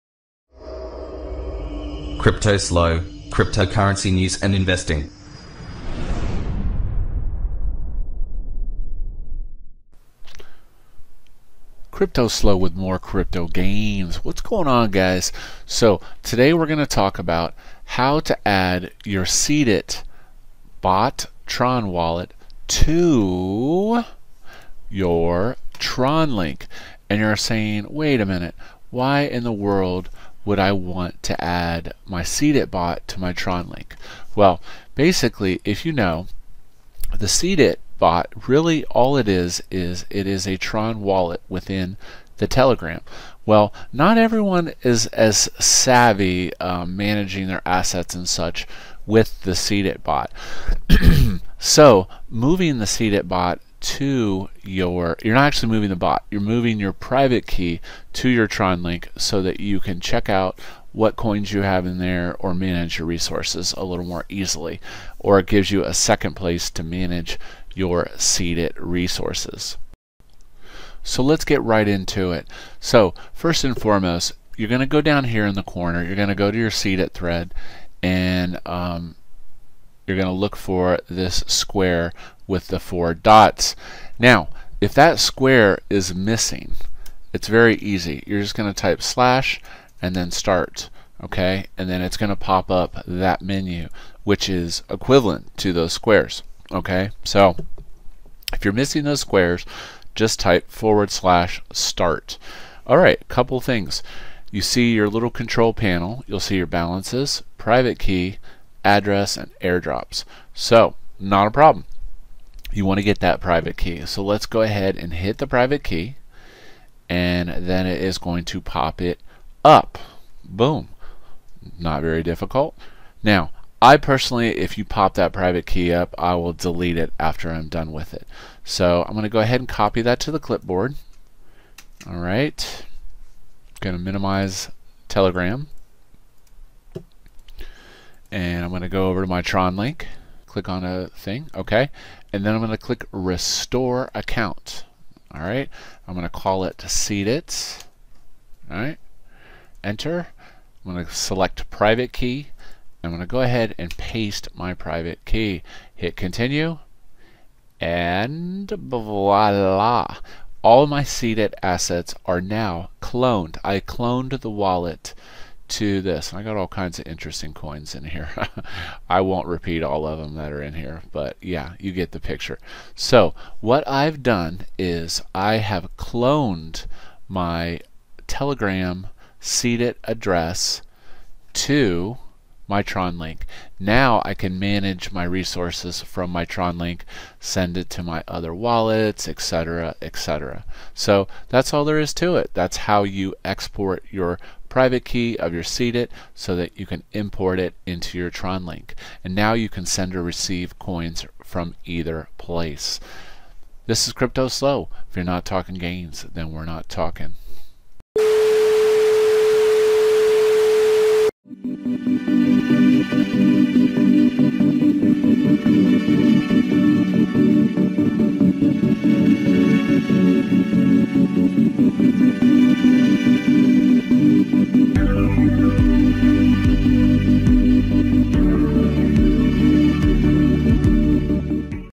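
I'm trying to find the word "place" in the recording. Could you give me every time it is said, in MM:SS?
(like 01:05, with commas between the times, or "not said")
01:06, 03:22.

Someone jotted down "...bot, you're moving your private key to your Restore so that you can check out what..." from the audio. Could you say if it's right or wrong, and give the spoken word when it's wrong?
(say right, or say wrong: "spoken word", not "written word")
wrong: "TronLink", not "Restore".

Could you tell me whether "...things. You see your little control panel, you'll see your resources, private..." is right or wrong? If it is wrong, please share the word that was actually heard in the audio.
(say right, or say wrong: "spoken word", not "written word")
wrong: "balances", not "resources".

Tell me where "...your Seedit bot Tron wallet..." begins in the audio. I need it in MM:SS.
00:19.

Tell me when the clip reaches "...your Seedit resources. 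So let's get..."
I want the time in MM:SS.
01:07.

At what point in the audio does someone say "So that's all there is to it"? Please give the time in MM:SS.
03:10.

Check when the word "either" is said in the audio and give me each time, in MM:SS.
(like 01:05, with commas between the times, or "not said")
03:21.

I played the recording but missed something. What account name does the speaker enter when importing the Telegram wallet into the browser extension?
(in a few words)
Seed It.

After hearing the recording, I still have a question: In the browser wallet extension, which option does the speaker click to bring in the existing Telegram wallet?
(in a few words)
Restore Account.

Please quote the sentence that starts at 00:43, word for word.
Well, not everyone is as savvy um, managing their assets and such with the CDIT bot.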